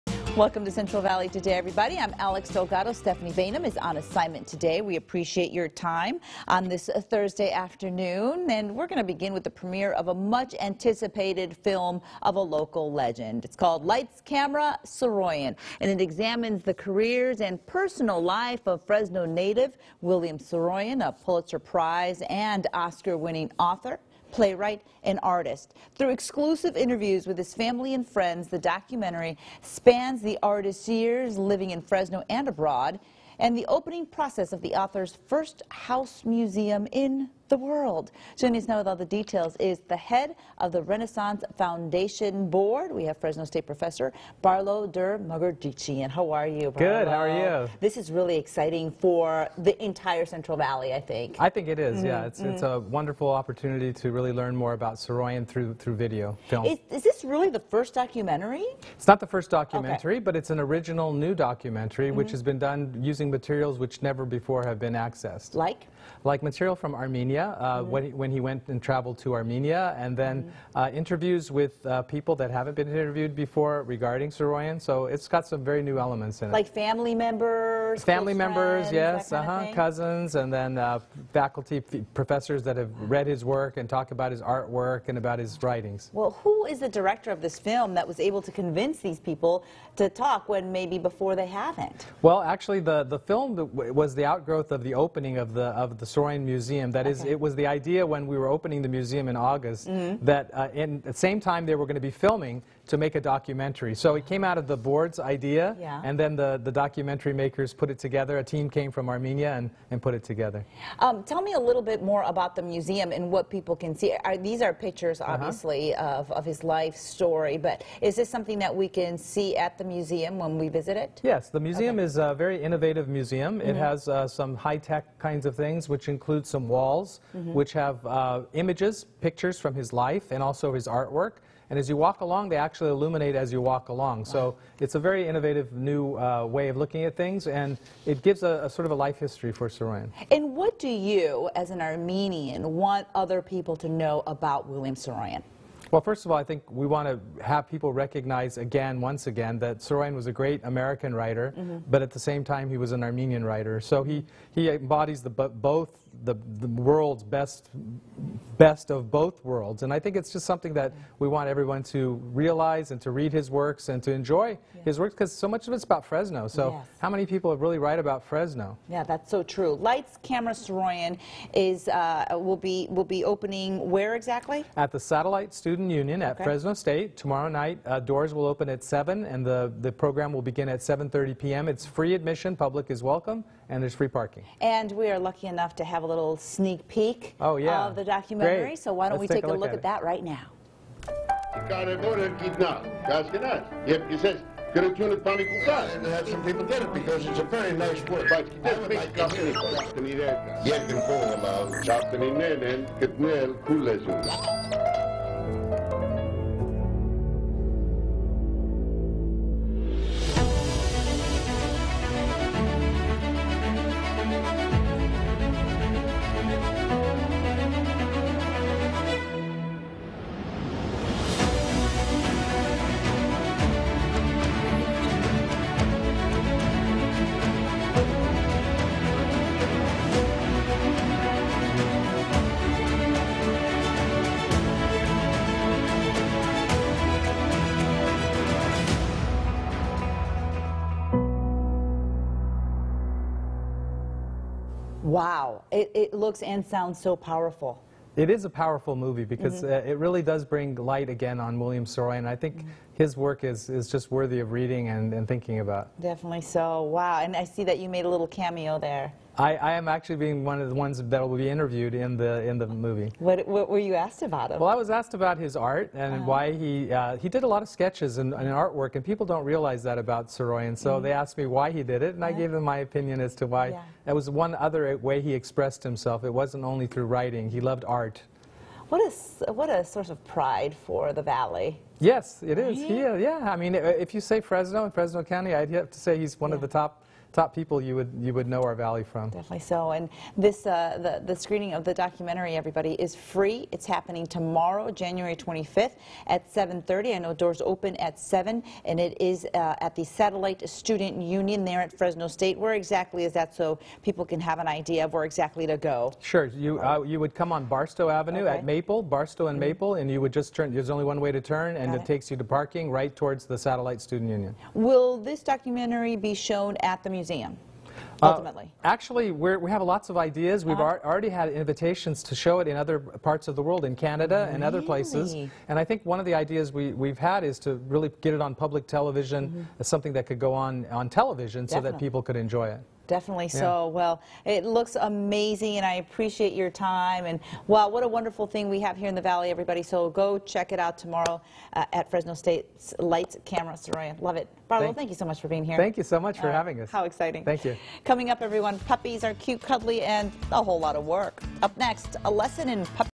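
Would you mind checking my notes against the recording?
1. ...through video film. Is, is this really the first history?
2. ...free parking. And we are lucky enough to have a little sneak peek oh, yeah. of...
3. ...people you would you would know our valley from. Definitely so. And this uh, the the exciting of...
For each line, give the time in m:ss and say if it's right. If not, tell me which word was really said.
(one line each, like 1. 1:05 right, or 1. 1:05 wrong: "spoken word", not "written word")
1. 0:55 wrong: "documentary", not "history"
2. 3:03 right
3. 4:47 wrong: "screening", not "exciting".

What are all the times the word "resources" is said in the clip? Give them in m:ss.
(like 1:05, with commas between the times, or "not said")
not said.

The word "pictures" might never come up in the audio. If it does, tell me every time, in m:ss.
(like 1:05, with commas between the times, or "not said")
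1:54, 2:09.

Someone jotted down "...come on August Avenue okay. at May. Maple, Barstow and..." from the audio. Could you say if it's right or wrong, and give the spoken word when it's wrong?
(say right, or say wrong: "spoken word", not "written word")
wrong: "Barstow", not "August".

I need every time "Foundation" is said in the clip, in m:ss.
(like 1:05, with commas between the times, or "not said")
0:41.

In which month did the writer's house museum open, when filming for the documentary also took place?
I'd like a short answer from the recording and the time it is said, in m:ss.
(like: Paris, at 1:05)
August, at 1:39.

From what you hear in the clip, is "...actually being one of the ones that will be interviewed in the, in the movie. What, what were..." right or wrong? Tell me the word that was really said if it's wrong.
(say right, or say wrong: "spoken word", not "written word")
right.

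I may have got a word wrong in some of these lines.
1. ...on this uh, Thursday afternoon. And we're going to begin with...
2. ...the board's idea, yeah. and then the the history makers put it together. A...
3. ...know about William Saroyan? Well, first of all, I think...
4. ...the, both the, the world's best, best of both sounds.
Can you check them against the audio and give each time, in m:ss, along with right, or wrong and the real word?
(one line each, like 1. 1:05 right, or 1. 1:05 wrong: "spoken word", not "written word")
1. 0:06 right
2. 1:44 wrong: "documentary", not "history"
3. 2:23 right
4. 2:35 wrong: "worlds", not "sounds".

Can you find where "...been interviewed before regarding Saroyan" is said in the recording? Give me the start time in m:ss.
1:12.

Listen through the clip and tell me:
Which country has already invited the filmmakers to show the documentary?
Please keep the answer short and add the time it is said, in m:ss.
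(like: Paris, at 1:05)
Canada, at 5:23.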